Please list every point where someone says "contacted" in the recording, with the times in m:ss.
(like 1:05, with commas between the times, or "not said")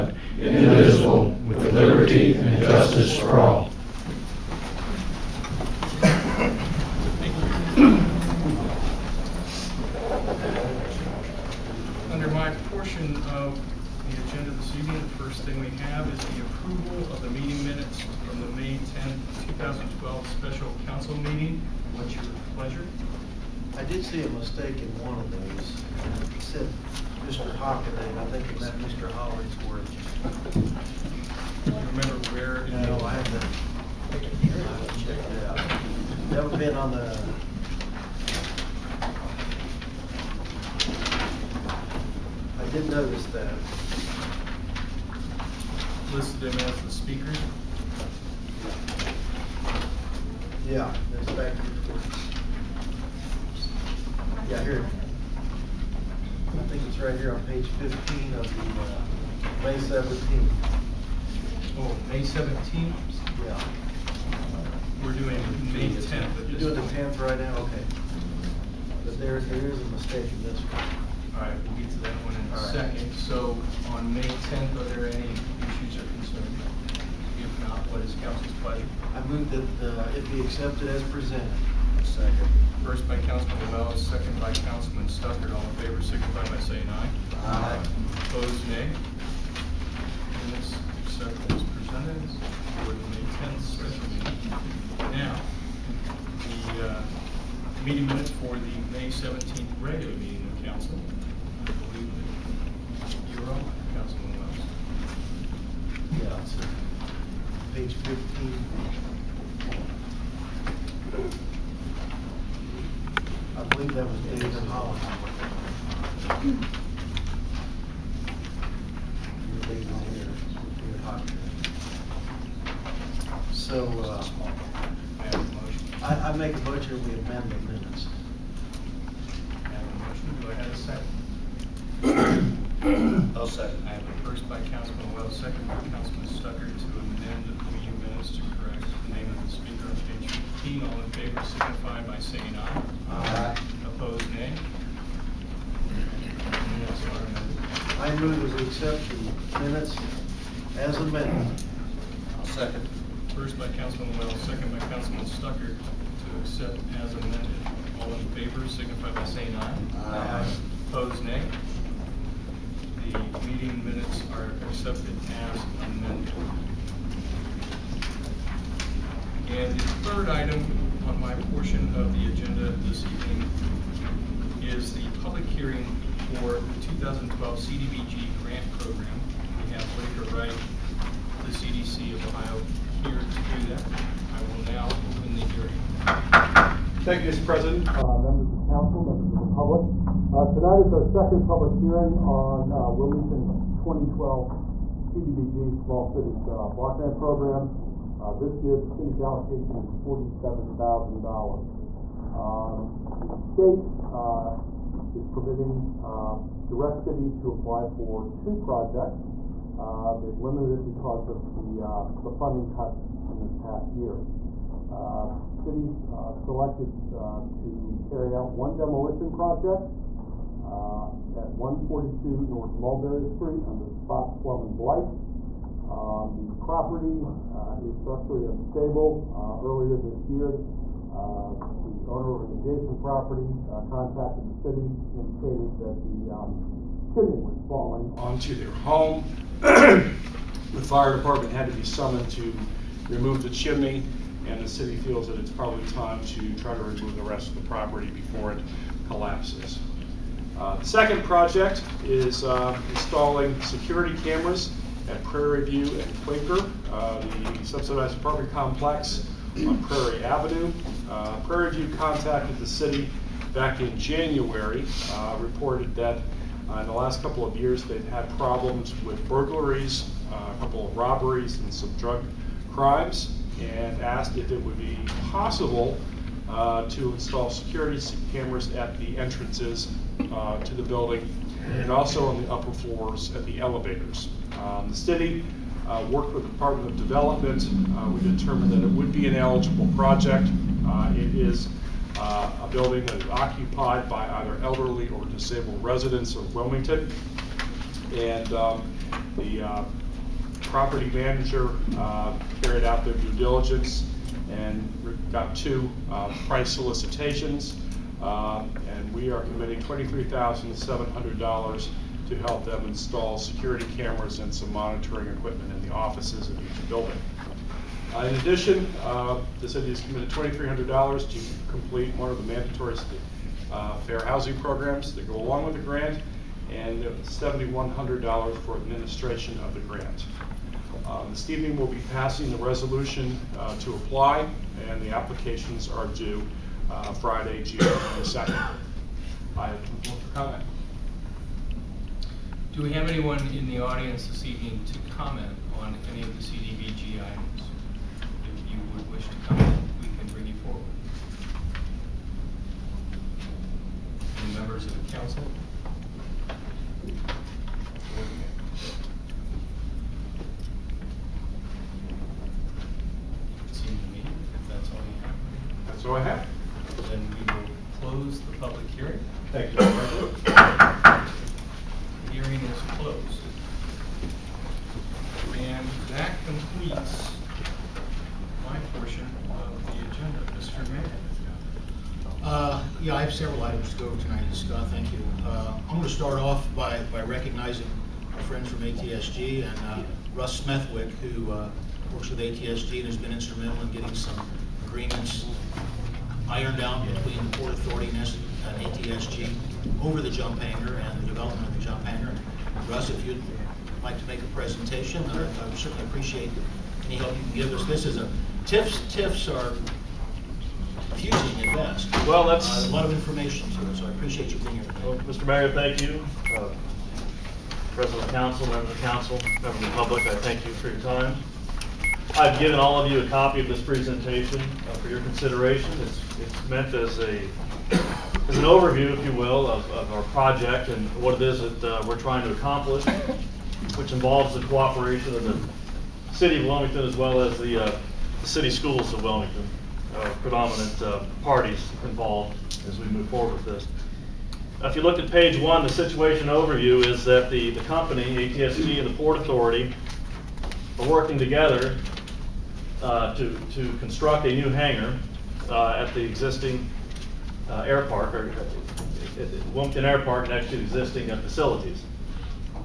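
3:53, 4:21.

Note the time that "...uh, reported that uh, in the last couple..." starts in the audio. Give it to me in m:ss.
4:25.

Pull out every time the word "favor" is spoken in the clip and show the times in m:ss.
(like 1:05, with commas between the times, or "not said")
1:25, 2:21, 2:38.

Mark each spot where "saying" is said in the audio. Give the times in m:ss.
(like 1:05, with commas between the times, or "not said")
1:26, 2:22, 2:39.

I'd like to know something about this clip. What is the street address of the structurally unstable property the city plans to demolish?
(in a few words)
142 North Mulberry Street.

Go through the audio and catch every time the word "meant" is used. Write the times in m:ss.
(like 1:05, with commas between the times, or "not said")
0:28, 7:06.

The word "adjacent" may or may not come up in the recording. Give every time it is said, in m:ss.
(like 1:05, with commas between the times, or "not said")
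3:52.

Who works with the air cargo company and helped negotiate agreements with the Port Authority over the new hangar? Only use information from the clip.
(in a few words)
Russ Smethwick.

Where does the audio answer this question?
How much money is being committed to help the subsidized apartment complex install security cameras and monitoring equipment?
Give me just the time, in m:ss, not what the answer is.
5:09.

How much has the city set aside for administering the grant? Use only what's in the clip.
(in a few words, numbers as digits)
$7,100.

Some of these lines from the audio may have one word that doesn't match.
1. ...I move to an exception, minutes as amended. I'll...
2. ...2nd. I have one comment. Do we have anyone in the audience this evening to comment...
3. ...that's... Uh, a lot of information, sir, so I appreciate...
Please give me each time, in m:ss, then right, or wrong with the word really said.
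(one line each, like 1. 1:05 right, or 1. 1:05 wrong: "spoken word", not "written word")
1. 2:27 right
2. 5:37 right
3. 6:52 right.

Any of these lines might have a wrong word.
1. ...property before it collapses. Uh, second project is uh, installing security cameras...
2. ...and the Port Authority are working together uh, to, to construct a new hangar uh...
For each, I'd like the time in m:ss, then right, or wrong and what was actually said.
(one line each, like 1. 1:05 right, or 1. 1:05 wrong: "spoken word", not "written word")
1. 4:07 right
2. 7:28 right.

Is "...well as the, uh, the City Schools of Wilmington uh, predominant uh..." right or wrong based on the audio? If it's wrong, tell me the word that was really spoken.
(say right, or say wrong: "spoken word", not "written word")
right.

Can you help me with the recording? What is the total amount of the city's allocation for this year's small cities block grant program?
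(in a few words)
$47,000.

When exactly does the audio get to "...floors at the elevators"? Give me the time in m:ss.
4:42.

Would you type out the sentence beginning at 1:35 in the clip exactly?
Now, the uh, meeting minutes for the May 17th regular meeting of council.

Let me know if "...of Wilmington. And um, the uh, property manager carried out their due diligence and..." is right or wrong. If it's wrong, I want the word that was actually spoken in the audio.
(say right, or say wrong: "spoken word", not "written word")
right.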